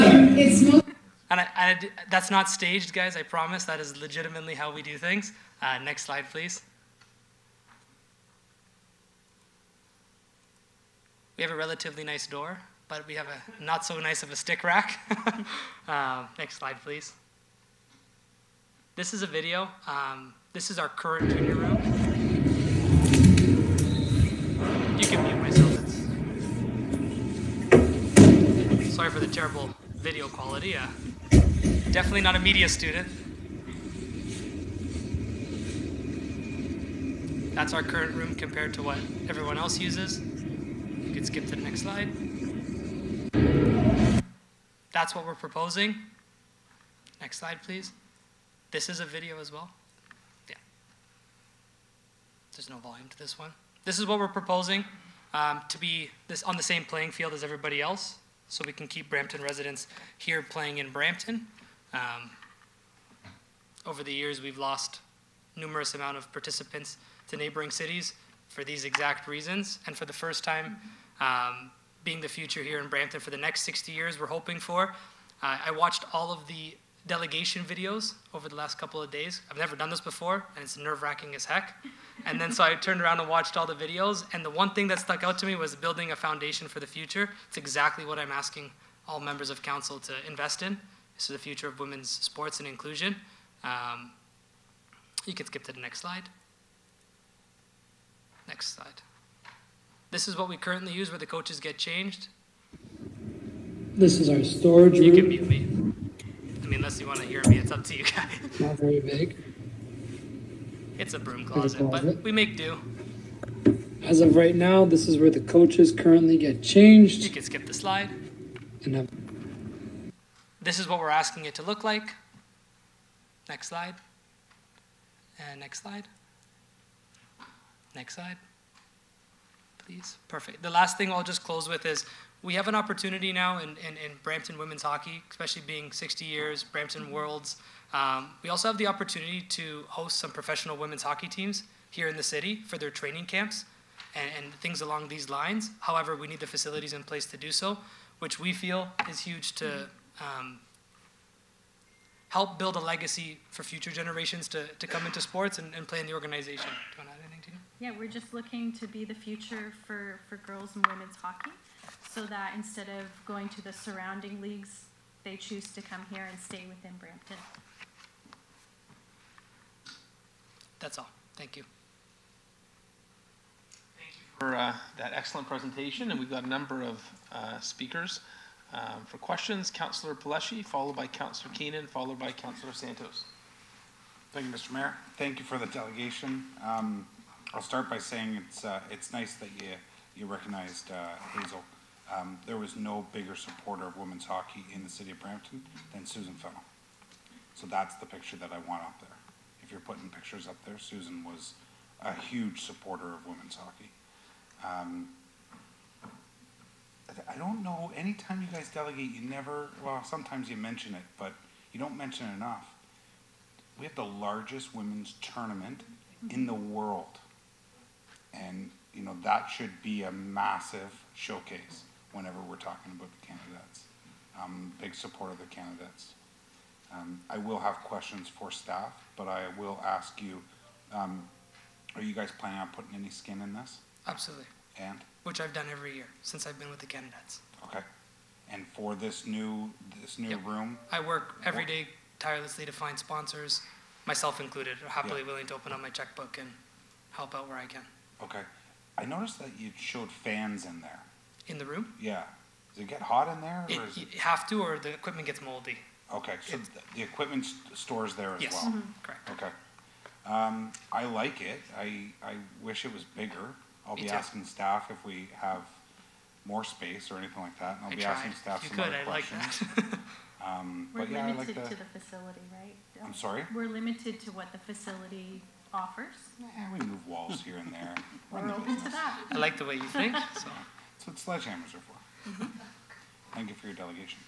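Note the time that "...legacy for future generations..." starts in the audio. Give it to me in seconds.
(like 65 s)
152 s.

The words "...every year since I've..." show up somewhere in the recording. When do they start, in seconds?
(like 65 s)
235 s.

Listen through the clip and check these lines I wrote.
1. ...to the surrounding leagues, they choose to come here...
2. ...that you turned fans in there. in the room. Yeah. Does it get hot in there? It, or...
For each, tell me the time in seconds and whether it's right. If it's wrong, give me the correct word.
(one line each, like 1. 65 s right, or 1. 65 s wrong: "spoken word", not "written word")
1. 163 s right
2. 249 s wrong: "showed", not "turned".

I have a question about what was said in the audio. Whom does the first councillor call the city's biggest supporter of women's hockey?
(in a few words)
Susan Fennell.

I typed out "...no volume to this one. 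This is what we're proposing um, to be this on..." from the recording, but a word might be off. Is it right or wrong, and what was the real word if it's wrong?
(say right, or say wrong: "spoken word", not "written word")
right.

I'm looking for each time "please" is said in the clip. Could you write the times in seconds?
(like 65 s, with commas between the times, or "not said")
6 s, 16 s, 47 s, 129 s.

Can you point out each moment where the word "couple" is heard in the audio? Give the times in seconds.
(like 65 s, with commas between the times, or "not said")
78 s.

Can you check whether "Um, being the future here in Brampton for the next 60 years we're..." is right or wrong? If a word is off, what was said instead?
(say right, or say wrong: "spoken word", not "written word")
right.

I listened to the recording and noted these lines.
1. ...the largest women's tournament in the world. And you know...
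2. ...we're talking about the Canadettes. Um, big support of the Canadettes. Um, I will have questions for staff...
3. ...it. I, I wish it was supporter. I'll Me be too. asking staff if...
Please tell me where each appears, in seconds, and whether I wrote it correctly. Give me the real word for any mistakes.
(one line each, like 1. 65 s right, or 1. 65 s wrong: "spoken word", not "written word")
1. 213 s right
2. 222 s right
3. 261 s wrong: "bigger", not "supporter".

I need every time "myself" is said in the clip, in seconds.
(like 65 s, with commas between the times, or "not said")
25 s, 244 s.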